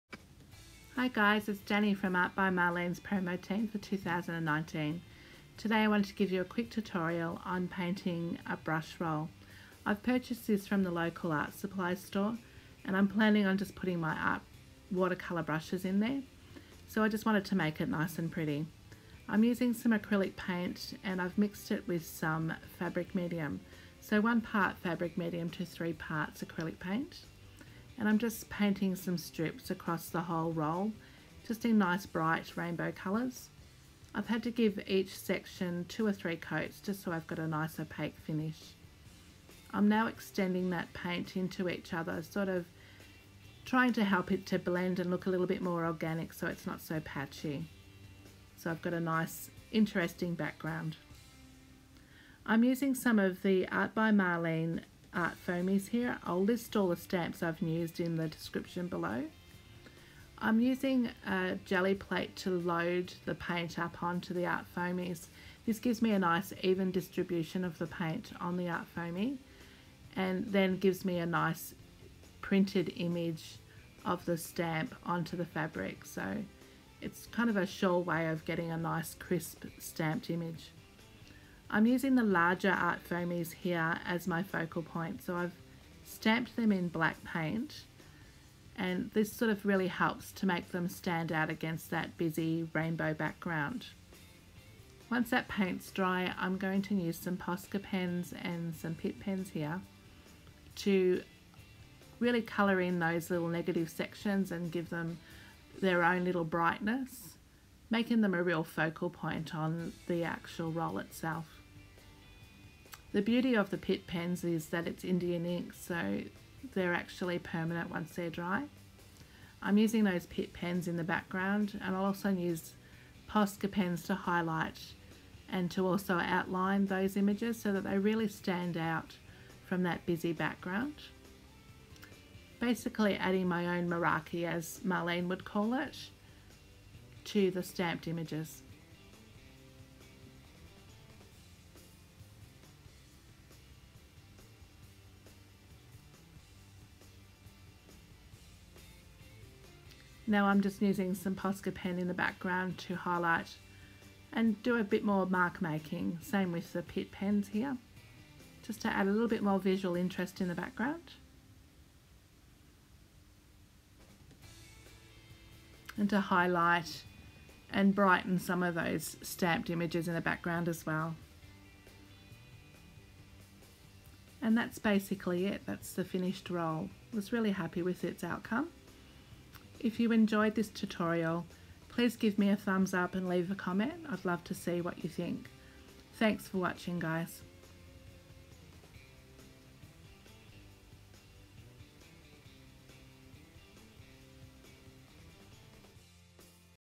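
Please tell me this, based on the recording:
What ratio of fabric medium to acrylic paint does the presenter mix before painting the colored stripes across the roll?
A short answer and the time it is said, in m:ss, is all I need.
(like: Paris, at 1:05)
1 to 3, at 0:24.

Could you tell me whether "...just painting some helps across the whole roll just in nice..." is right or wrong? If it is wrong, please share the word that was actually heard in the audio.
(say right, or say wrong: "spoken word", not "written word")
wrong: "strips", not "helps".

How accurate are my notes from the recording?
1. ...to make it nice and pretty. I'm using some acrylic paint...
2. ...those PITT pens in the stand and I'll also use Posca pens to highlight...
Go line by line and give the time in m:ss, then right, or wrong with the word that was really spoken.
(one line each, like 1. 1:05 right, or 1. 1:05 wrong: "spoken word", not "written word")
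1. 0:17 right
2. 2:00 wrong: "background", not "stand".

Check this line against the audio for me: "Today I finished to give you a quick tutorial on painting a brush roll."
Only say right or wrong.
wrong.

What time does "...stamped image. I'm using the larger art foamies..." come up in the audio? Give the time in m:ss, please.
1:19.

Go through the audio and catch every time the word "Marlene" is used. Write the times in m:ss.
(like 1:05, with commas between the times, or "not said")
0:02, 0:54, 2:14.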